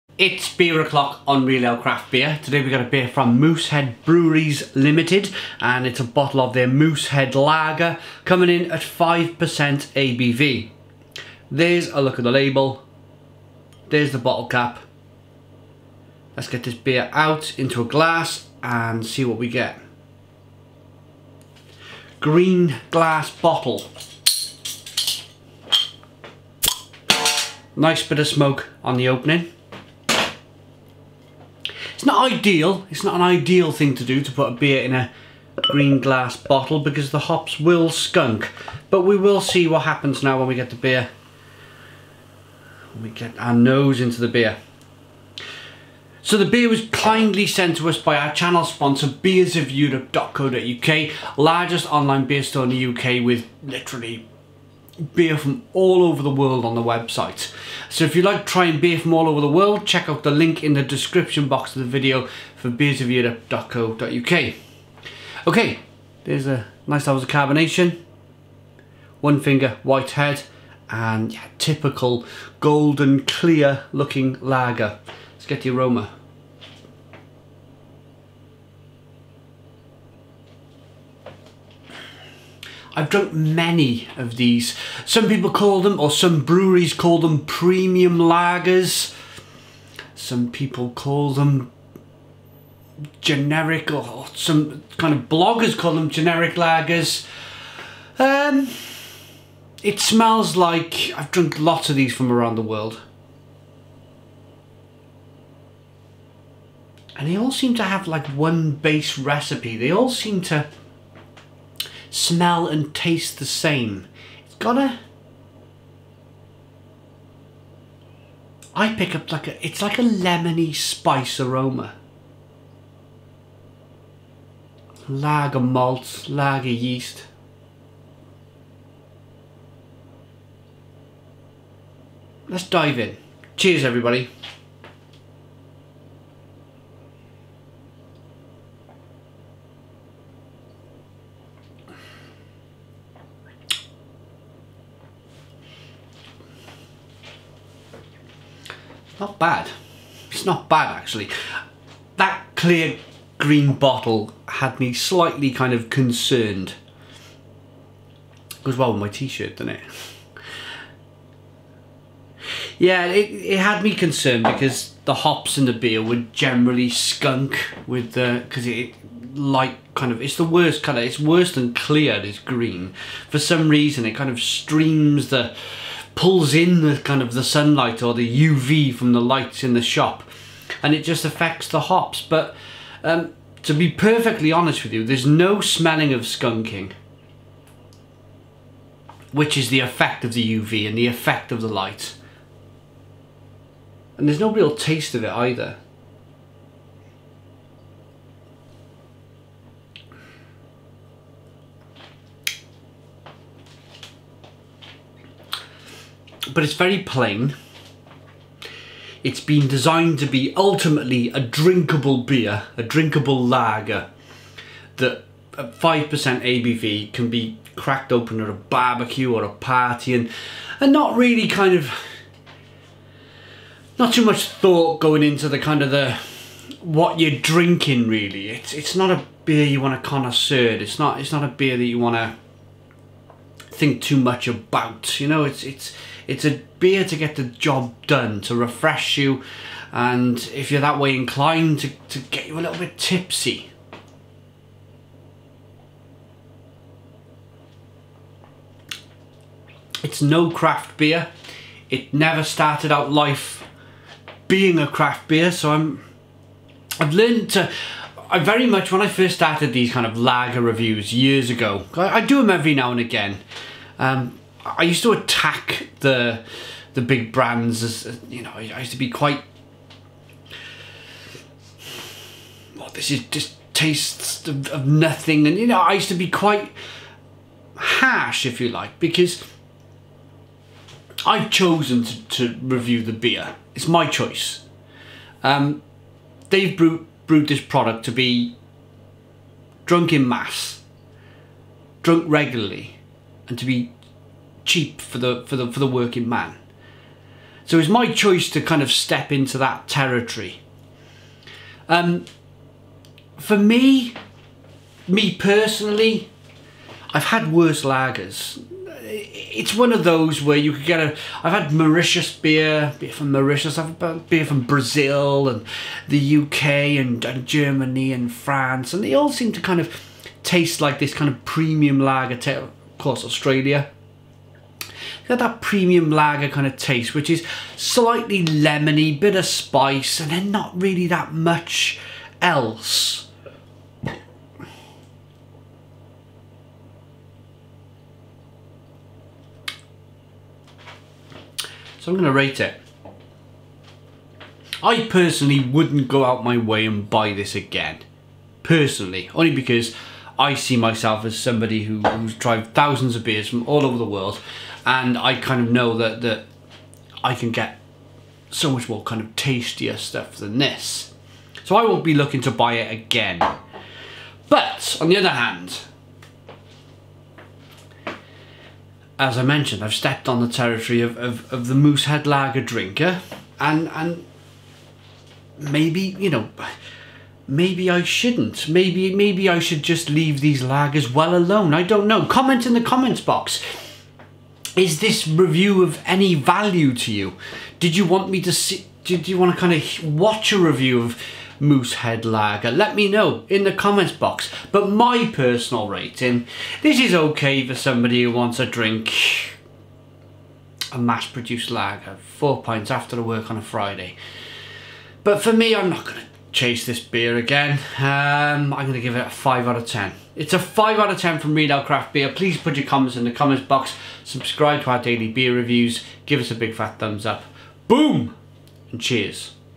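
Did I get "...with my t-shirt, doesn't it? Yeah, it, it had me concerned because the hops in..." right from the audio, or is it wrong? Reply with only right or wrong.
right.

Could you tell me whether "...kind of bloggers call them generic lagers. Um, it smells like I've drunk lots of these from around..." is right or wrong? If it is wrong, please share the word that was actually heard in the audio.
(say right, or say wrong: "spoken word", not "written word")
right.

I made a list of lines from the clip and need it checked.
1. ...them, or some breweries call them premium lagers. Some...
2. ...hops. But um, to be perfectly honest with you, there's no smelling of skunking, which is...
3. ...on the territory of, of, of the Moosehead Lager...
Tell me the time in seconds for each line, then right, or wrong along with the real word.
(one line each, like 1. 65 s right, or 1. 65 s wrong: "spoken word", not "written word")
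1. 85 s right
2. 181 s right
3. 370 s right.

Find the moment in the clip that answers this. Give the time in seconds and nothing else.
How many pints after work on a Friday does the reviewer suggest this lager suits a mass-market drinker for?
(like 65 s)
402 s.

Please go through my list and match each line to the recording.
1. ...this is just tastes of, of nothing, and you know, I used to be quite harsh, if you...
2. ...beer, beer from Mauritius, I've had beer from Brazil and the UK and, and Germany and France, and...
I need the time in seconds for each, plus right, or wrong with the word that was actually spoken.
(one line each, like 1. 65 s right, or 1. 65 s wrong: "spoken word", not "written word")
1. 272 s right
2. 312 s right.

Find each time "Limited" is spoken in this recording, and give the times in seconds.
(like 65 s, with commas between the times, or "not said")
4 s.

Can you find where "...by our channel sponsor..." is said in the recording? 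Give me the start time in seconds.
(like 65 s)
47 s.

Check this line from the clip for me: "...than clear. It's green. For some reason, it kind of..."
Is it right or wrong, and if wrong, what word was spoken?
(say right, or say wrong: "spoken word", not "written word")
right.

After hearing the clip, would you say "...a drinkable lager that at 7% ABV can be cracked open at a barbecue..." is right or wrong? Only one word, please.
wrong.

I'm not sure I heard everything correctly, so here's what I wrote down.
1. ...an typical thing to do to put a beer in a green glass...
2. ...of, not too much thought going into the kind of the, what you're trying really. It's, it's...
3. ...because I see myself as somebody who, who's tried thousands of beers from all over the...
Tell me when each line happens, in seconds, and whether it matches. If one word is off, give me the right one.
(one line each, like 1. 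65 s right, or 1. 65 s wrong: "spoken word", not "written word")
1. 33 s wrong: "ideal", not "typical"
2. 221 s wrong: "drinking", not "trying"
3. 349 s right.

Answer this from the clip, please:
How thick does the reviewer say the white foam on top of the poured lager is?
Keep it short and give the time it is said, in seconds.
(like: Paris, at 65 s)
One finger, at 69 s.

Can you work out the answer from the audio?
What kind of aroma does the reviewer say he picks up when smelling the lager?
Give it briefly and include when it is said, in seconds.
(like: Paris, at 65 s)
lemony spice, at 120 s.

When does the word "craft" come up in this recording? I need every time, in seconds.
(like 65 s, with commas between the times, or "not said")
1 s, 250 s, 254 s, 411 s.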